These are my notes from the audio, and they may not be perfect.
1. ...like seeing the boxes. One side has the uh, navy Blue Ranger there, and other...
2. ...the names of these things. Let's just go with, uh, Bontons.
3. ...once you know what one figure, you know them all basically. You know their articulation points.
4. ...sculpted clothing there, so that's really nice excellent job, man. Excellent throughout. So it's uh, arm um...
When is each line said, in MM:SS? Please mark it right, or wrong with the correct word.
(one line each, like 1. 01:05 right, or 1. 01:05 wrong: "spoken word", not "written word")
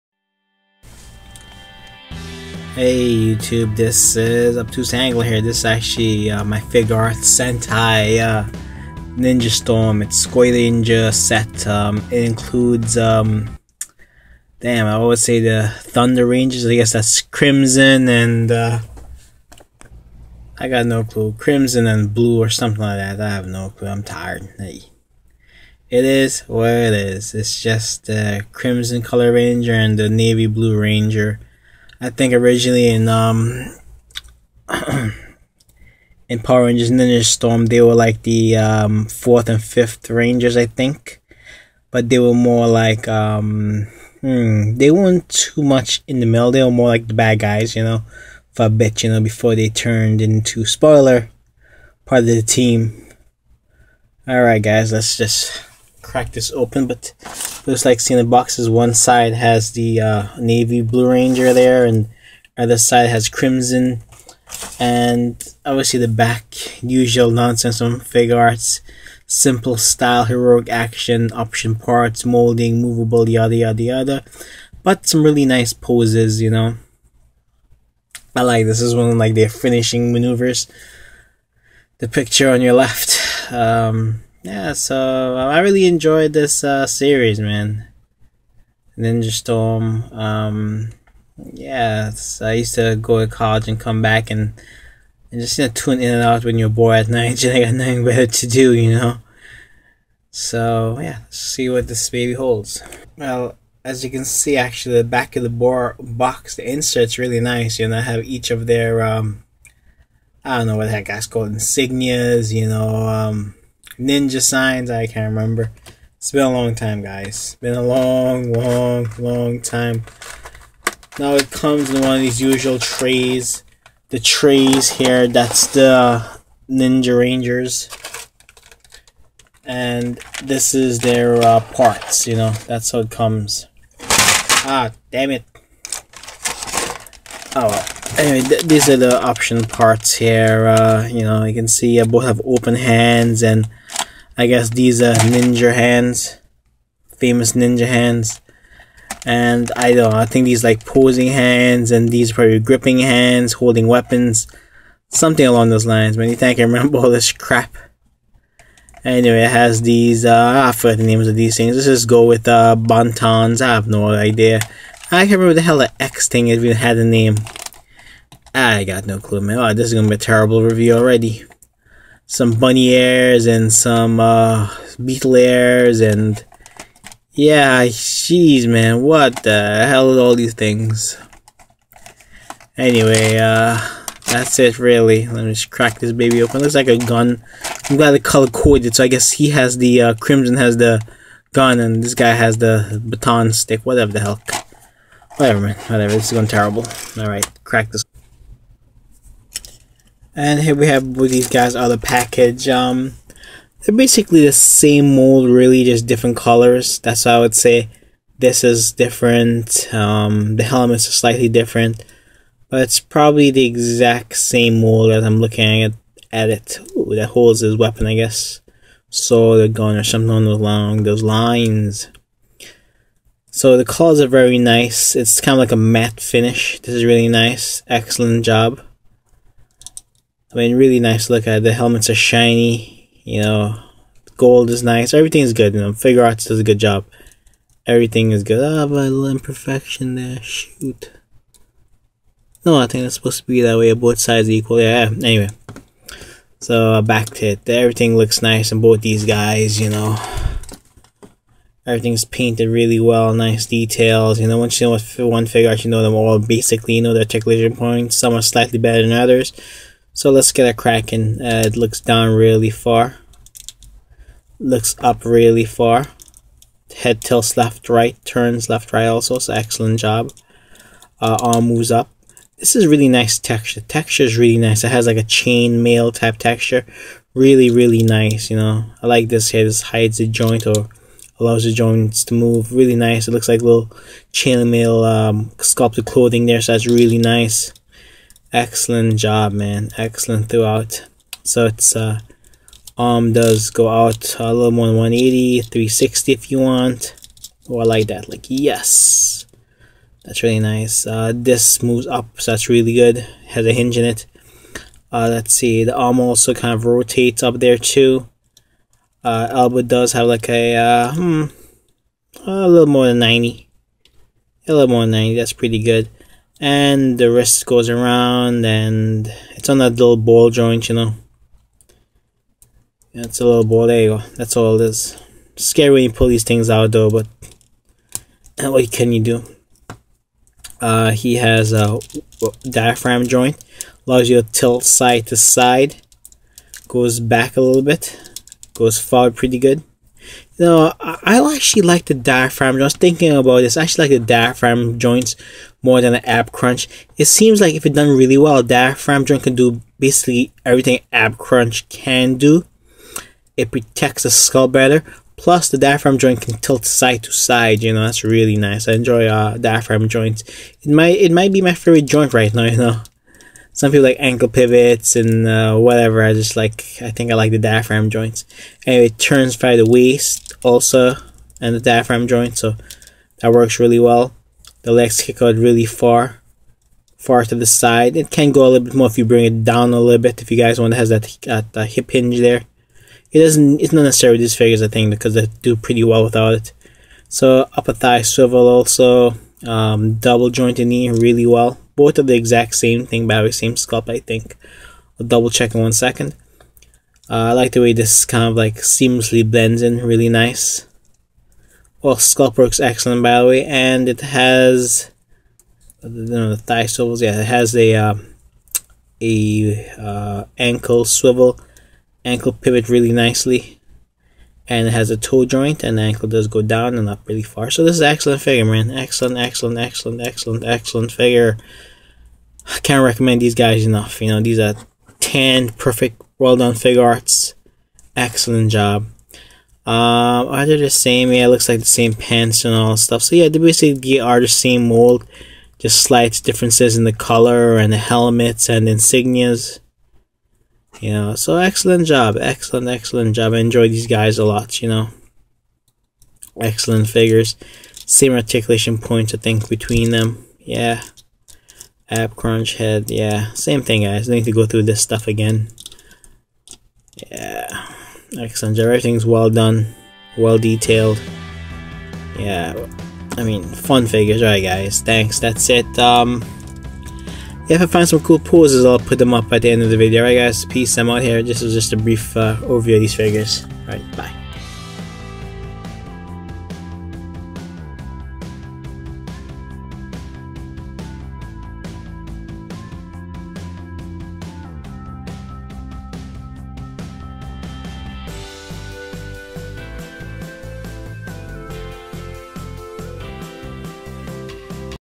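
1. 00:57 right
2. 02:40 right
3. 04:14 right
4. 04:45 right.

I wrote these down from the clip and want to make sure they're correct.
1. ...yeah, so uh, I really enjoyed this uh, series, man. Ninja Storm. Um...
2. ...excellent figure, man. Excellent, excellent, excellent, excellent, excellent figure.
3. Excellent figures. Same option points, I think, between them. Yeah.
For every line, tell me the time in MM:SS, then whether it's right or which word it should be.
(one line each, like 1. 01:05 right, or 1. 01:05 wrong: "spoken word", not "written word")
1. 01:24 right
2. 06:58 right
3. 07:26 wrong: "articulation", not "option".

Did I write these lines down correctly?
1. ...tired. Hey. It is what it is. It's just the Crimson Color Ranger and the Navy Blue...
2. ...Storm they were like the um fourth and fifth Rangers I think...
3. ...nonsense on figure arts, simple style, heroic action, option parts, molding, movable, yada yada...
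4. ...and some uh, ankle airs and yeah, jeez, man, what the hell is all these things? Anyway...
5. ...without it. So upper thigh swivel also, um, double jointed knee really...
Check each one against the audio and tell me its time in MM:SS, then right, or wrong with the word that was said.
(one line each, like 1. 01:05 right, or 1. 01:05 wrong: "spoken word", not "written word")
1. 00:24 right
2. 00:37 right
3. 01:07 right
4. 02:53 wrong: "beetle", not "ankle"
5. 06:26 right.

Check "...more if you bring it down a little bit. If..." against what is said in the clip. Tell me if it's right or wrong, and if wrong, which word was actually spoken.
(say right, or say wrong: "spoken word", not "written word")
right.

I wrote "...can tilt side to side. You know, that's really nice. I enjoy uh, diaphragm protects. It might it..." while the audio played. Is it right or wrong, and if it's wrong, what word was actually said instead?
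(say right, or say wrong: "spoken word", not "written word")
wrong: "joints", not "protects".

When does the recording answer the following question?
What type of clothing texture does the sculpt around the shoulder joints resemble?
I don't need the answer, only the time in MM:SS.
04:35.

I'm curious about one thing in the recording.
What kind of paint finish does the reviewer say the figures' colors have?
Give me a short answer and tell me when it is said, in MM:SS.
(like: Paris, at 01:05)
Matte finish, at 03:45.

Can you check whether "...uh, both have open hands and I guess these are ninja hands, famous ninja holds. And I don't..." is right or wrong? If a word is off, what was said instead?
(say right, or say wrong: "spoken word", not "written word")
wrong: "hands", not "holds".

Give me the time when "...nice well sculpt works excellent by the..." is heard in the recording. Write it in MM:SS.
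06:40.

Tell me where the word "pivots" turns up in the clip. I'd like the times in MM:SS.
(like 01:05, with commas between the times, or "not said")
06:04, 06:52.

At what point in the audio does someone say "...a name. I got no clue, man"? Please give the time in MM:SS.
02:46.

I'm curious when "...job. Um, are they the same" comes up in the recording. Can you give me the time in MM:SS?
07:08.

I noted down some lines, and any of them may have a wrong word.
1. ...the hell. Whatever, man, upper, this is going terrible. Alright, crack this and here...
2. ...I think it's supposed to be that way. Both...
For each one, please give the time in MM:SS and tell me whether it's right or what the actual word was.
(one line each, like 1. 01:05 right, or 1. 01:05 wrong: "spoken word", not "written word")
1. 03:14 wrong: "whatever", not "upper"
2. 04:02 right.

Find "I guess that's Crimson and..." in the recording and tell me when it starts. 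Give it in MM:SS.
00:16.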